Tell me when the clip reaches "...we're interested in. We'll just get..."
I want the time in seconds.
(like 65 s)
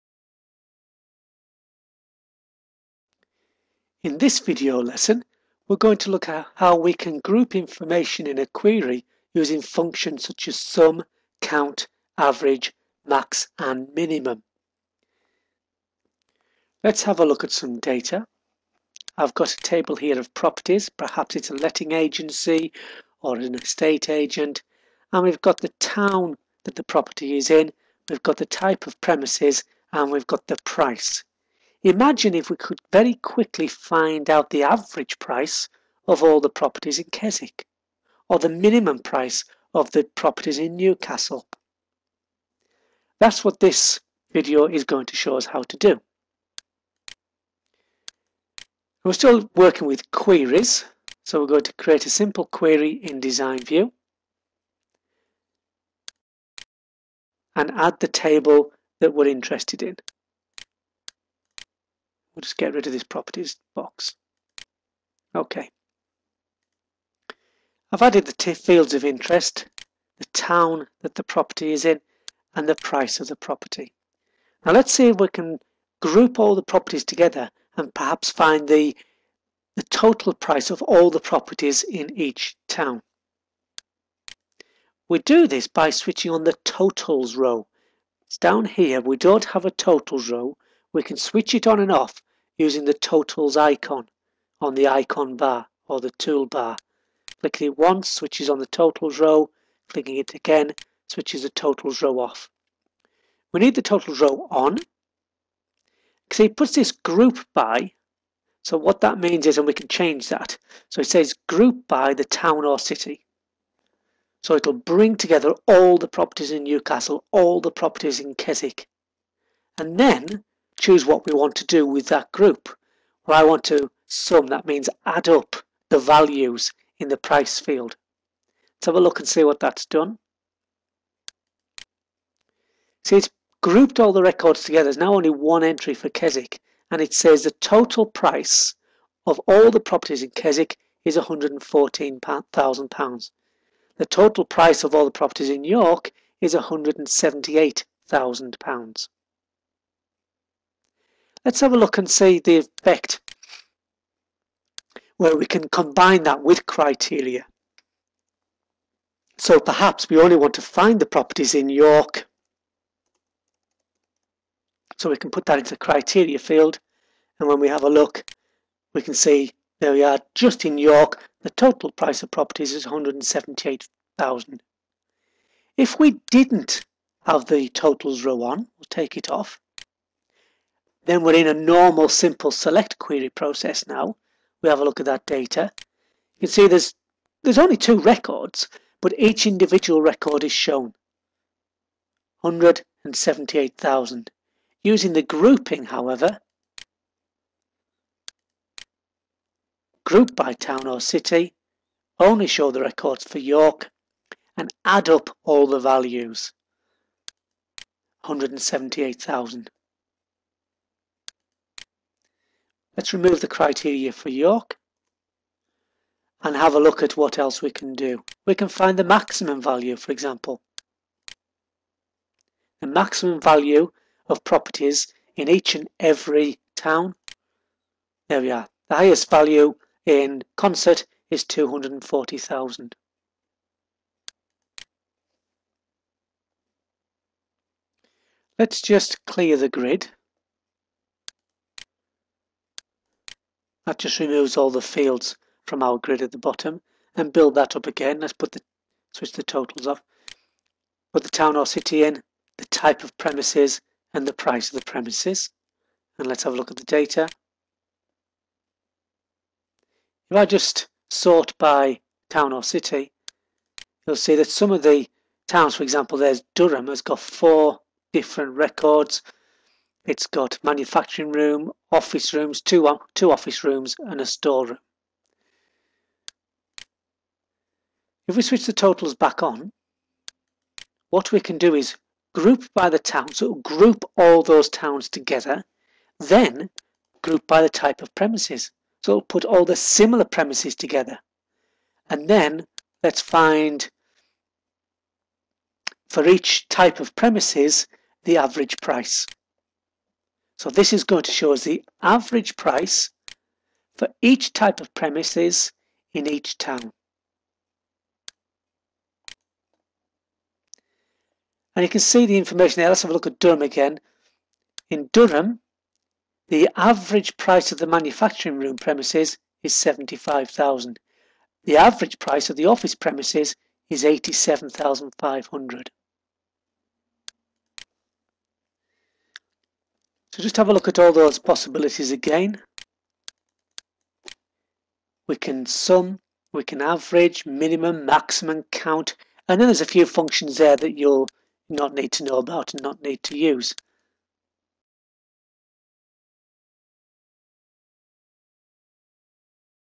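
59 s.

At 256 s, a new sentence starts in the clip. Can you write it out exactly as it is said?
And let's have a look at the data.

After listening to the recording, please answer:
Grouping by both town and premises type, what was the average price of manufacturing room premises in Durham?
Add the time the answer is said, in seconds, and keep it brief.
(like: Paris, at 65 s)
75,000, at 319 s.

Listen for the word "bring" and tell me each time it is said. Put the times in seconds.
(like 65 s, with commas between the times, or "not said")
114 s.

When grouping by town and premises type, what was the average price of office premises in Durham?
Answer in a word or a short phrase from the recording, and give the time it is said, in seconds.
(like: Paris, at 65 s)
87,500, at 324 s.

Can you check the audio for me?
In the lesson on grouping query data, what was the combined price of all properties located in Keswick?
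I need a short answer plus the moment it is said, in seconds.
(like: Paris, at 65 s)
£114,000, at 141 s.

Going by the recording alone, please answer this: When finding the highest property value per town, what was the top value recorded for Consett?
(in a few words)
240,000.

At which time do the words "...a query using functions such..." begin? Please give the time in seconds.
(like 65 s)
8 s.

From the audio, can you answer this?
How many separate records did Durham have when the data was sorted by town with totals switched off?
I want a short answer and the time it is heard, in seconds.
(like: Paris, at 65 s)
4, at 267 s.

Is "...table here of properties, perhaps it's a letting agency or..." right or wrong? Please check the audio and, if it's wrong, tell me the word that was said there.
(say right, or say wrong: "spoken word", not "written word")
right.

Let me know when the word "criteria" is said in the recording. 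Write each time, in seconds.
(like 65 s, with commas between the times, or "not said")
156 s, 165 s, 213 s.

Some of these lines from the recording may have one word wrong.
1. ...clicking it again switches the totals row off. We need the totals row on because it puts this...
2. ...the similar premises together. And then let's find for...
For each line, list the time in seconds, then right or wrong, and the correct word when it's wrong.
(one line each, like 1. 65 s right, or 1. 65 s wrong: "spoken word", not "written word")
1. 99 s right
2. 289 s right.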